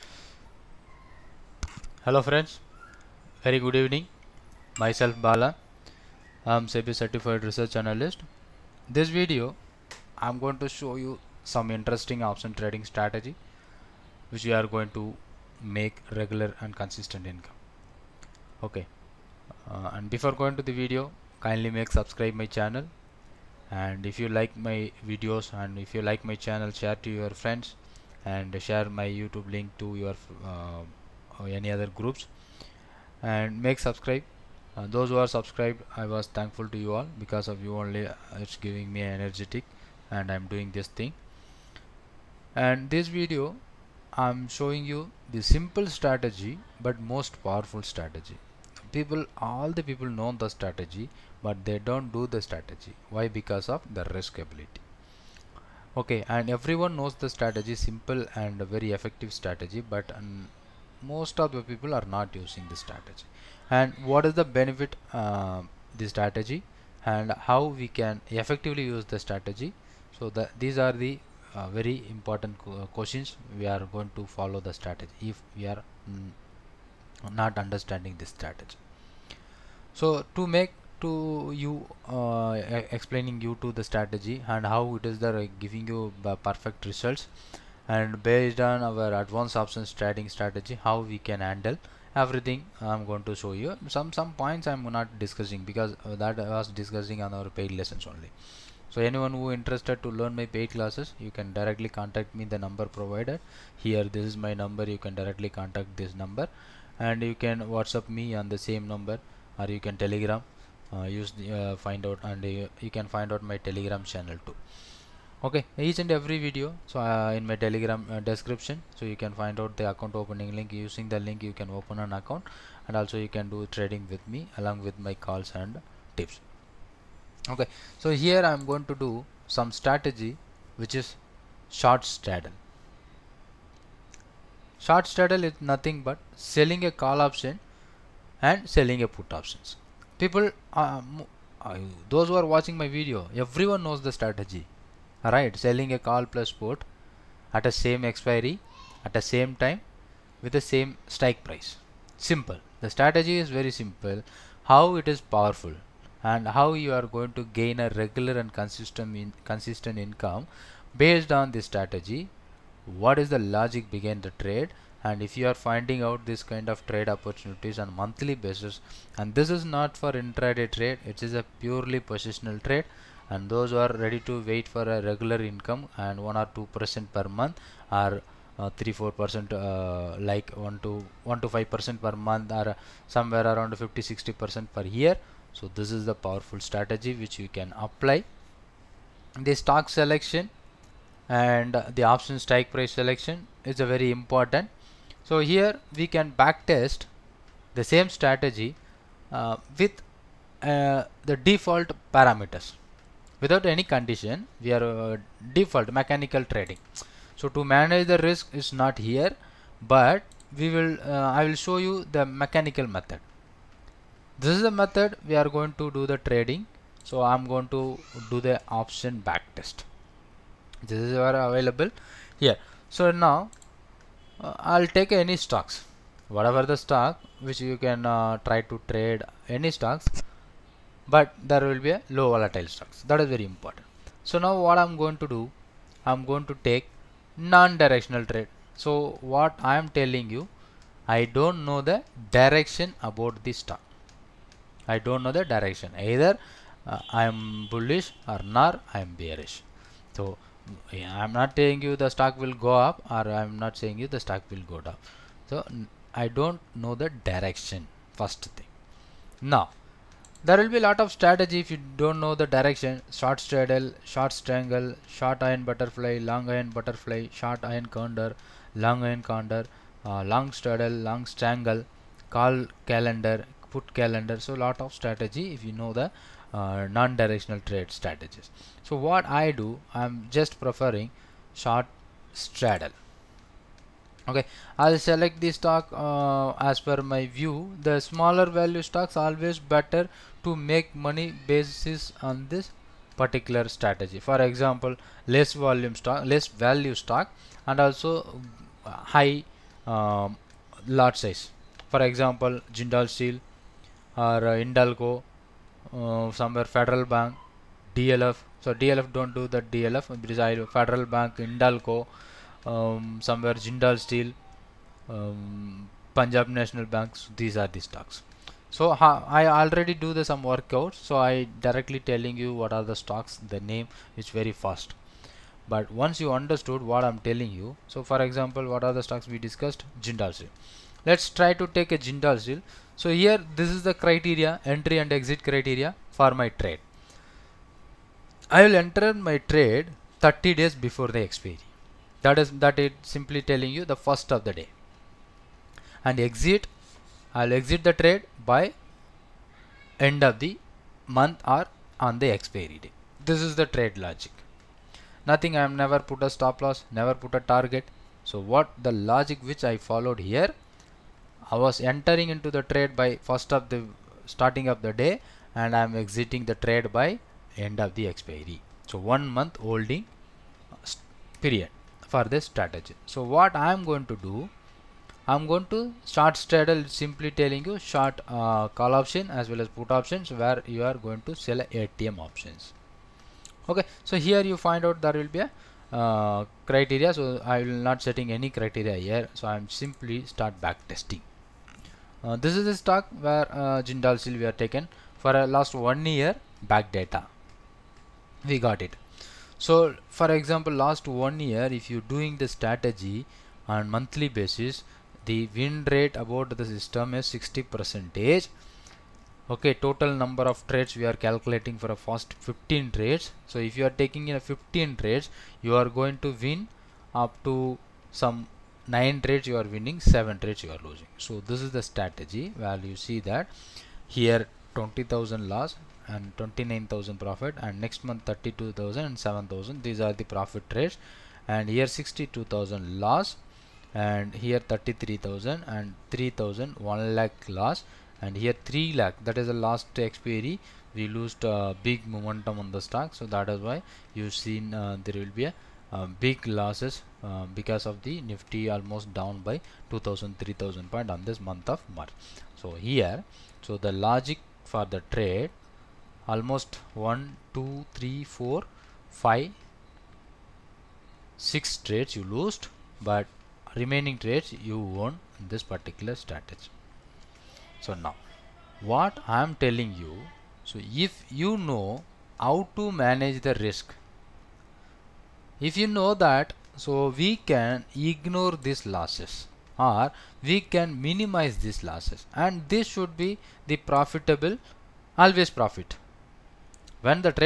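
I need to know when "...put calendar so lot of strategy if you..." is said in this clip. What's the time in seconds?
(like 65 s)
273 s.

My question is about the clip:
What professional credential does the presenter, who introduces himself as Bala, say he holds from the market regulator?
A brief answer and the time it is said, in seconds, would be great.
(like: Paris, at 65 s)
SEBI certified research analyst, at 6 s.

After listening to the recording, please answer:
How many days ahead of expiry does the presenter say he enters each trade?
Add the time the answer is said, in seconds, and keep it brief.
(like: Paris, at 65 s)
30 days, at 340 s.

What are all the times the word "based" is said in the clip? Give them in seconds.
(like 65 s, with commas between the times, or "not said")
88 s, 160 s.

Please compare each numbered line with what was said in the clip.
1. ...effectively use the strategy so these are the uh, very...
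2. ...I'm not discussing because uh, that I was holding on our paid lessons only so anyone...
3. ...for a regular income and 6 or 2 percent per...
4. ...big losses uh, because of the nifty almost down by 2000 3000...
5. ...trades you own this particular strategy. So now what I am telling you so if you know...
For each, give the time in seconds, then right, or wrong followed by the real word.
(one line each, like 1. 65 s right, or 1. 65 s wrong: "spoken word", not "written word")
1. 68 s right
2. 94 s wrong: "discussing", not "holding"
3. 174 s wrong: "1", not "6"
4. 446 s right
5. 464 s right.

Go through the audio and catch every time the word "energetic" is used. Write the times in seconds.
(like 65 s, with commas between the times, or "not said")
39 s.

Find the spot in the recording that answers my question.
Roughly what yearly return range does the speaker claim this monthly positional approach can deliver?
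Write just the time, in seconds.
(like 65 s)
183 s.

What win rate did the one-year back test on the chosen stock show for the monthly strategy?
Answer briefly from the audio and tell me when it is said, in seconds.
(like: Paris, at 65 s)
60 percent, at 407 s.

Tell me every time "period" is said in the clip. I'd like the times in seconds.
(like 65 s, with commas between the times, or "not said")
371 s.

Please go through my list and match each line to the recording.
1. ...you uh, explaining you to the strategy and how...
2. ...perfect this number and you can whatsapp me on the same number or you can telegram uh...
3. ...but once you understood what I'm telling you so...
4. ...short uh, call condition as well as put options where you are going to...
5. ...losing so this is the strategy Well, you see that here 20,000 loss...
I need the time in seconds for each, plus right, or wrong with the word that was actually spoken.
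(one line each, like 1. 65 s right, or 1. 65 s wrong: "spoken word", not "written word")
1. 81 s right
2. 105 s wrong: "contact", not "perfect"
3. 325 s right
4. 377 s wrong: "option", not "condition"
5. 420 s right.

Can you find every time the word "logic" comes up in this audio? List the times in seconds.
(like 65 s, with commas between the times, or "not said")
163 s, 353 s, 358 s, 453 s.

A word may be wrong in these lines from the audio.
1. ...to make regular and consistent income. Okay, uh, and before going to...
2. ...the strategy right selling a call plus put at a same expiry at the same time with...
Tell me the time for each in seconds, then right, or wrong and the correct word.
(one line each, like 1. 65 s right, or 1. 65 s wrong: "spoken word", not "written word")
1. 14 s right
2. 144 s right.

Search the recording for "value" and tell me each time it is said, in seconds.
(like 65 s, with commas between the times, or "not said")
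288 s, 296 s.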